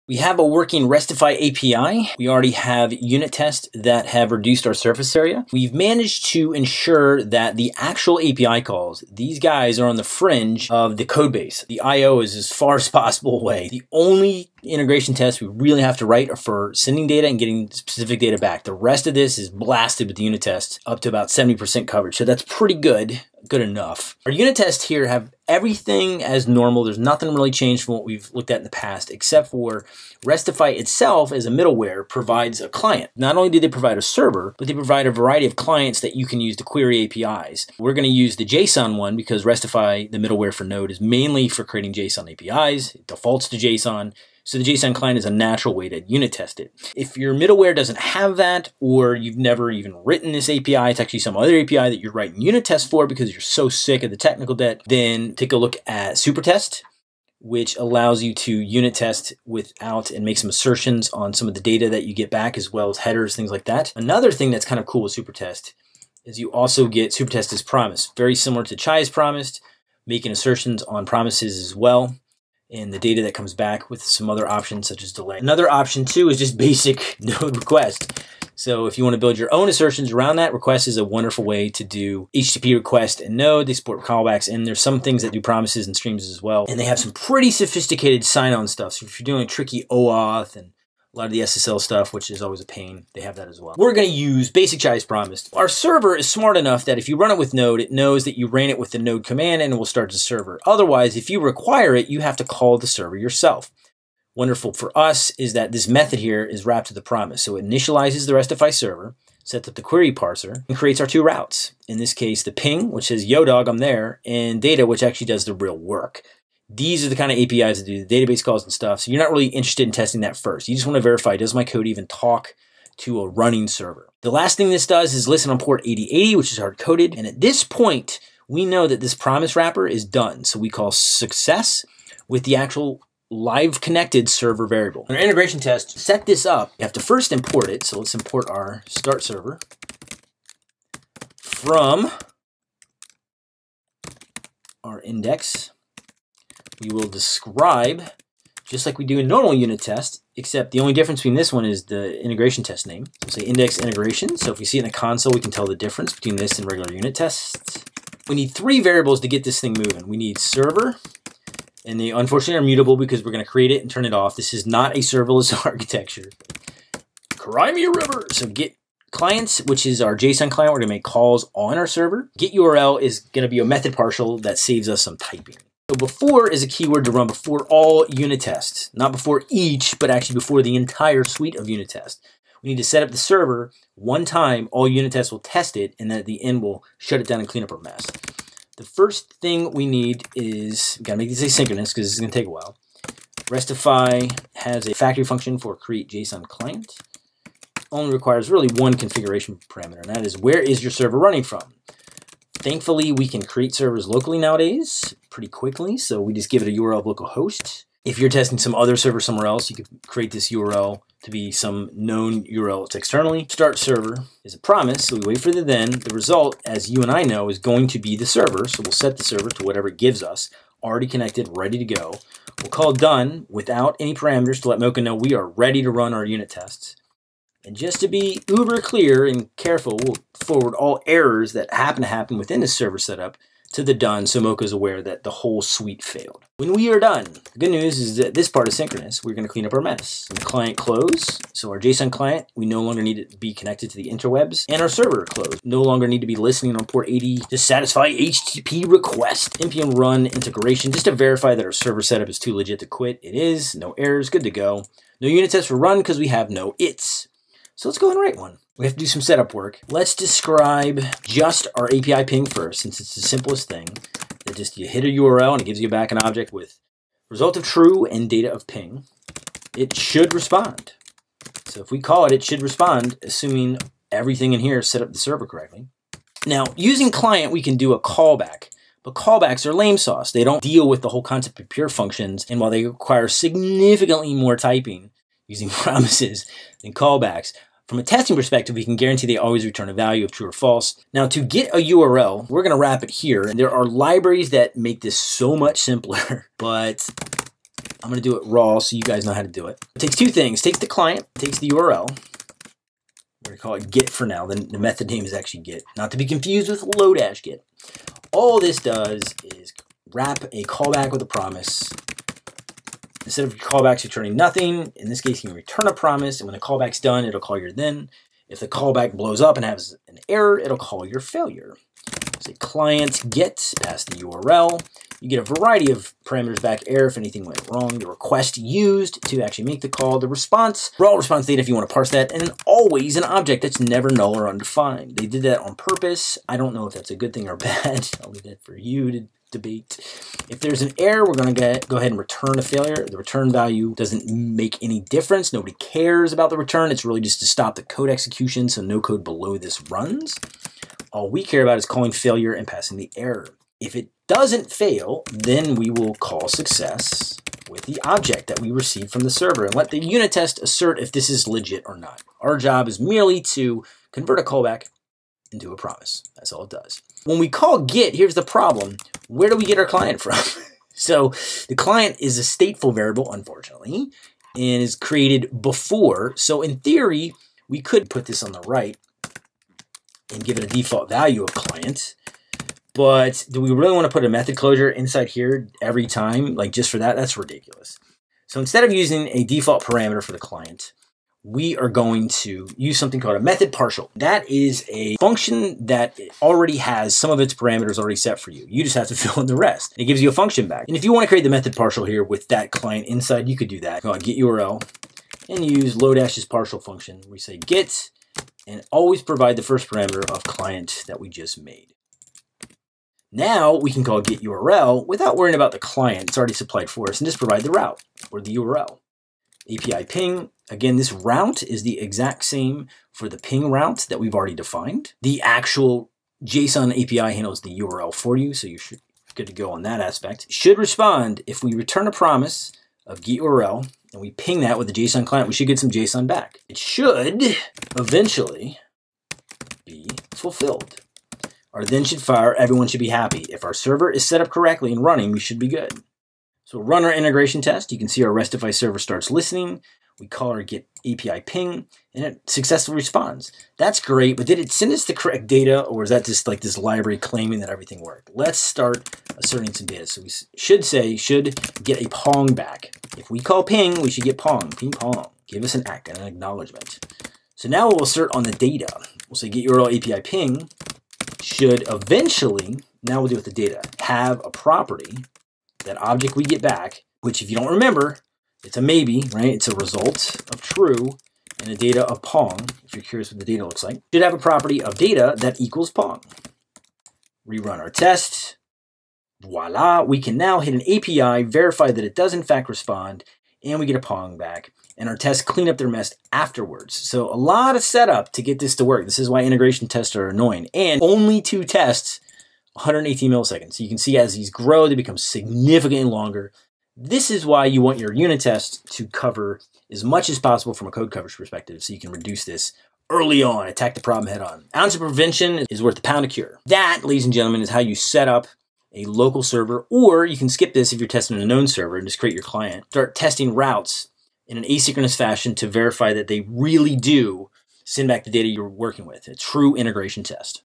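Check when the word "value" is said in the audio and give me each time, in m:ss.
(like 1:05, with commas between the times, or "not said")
4:49, 5:43, 6:21.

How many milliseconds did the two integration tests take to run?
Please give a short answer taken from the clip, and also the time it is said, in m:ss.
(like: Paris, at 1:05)
118, at 8:22.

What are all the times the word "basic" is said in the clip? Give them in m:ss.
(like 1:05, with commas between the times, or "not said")
1:16, 1:34.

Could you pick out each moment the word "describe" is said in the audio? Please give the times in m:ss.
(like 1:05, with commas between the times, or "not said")
2:27, 4:20.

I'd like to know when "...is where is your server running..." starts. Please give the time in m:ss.
3:20.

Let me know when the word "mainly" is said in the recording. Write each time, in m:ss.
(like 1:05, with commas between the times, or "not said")
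0:41.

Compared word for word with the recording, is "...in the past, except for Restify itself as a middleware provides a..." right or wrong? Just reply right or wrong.
right.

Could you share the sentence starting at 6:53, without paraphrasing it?
Now we can call get URL without worrying about the client.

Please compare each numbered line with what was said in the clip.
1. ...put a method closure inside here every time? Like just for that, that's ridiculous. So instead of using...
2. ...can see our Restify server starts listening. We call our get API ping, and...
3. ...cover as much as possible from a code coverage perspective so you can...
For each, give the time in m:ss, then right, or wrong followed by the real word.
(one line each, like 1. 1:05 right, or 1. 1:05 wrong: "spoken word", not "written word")
1. 6:24 right
2. 7:27 right
3. 8:29 right.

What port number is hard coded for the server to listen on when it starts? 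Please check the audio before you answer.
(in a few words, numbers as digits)
8080.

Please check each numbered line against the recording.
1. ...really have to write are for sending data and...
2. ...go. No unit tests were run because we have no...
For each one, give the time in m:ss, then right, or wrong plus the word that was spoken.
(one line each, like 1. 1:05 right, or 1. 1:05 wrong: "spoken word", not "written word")
1. 0:15 right
2. 4:14 right.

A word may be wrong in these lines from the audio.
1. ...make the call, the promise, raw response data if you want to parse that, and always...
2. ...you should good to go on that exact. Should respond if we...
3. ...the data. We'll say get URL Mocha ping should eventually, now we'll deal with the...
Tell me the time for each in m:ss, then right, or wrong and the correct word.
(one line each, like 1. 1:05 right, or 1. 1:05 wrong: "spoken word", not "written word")
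1. 5:29 wrong: "response", not "promise"
2. 7:08 wrong: "aspect", not "exact"
3. 7:48 wrong: "API", not "Mocha".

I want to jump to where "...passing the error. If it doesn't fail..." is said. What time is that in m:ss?
5:52.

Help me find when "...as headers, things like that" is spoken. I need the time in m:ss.
1:02.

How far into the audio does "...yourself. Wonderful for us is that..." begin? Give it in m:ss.
1:43.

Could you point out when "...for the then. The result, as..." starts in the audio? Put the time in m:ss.
3:35.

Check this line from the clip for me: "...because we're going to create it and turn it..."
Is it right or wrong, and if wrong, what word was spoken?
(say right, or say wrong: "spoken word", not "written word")
right.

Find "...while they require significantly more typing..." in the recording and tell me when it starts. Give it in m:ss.
4:42.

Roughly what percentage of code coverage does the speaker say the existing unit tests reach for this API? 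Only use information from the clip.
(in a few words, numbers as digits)
70%.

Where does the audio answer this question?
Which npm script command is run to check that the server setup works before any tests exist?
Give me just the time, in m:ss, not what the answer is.
4:09.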